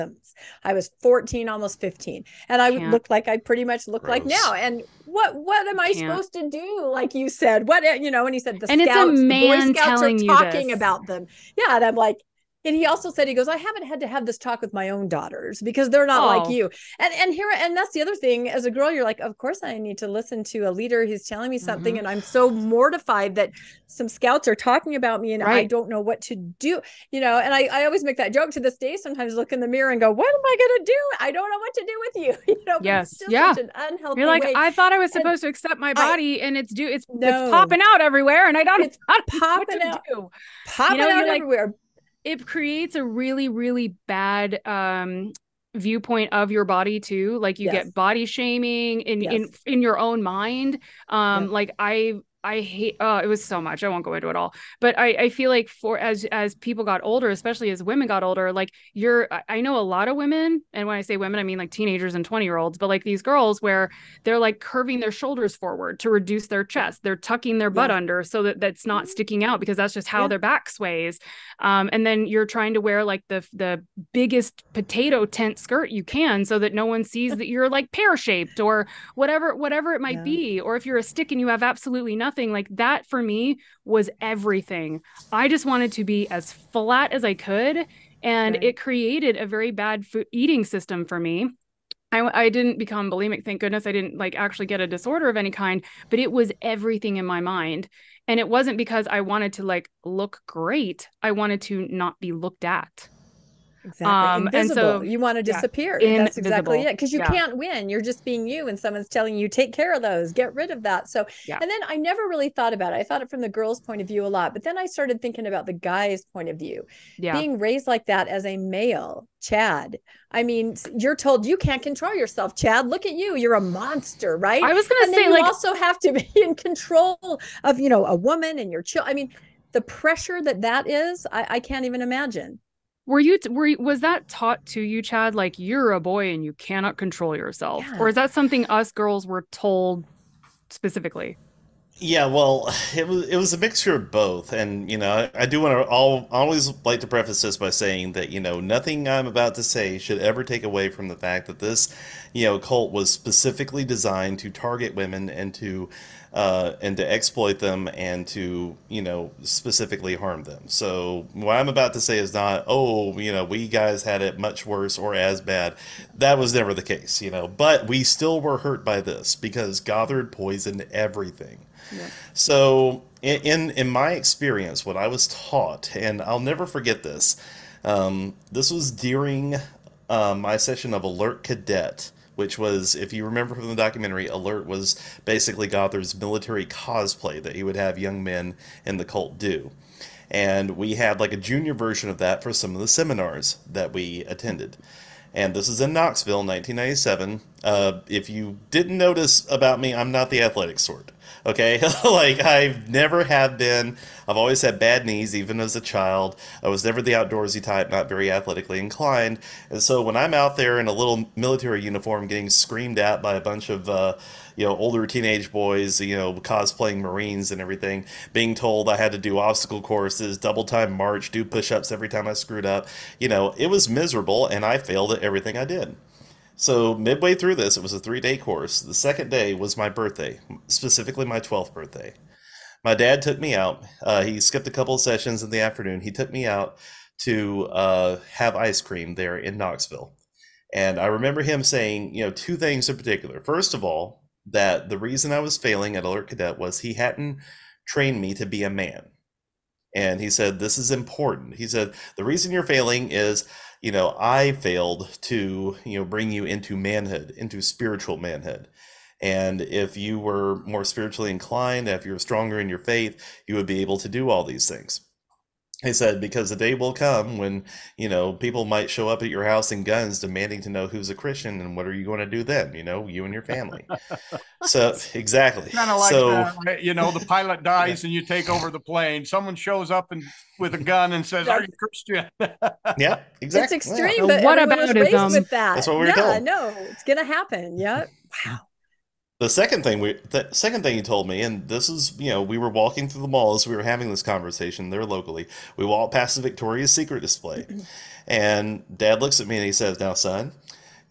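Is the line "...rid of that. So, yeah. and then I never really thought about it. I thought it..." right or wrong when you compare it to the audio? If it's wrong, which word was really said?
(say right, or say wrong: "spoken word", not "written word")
right.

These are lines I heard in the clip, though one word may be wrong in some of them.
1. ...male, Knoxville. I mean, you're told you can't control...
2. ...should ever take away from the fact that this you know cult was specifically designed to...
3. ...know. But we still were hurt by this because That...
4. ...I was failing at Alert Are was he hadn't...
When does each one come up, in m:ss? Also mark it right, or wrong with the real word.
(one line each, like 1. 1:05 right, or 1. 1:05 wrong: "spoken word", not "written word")
1. 1:58 wrong: "Chad", not "Knoxville"
2. 2:29 right
3. 2:47 wrong: "Gothard", not "That"
4. 4:05 wrong: "Cadet", not "Are".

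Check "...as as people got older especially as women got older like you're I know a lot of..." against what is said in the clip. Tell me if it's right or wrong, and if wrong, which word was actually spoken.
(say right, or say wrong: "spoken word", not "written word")
right.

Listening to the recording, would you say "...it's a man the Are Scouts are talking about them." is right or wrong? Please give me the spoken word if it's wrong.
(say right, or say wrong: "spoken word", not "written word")
wrong: "Boy", not "Are".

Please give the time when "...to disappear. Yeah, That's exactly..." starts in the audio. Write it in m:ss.
1:45.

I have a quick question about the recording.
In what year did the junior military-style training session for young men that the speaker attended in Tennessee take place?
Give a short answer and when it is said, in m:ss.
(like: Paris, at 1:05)
1997, at 3:16.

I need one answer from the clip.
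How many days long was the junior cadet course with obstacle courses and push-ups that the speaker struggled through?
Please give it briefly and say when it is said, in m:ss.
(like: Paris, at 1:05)
3, at 3:47.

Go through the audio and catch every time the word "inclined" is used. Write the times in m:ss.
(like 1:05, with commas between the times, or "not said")
3:28, 4:21.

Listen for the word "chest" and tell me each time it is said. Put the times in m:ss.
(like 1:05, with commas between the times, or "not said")
1:06.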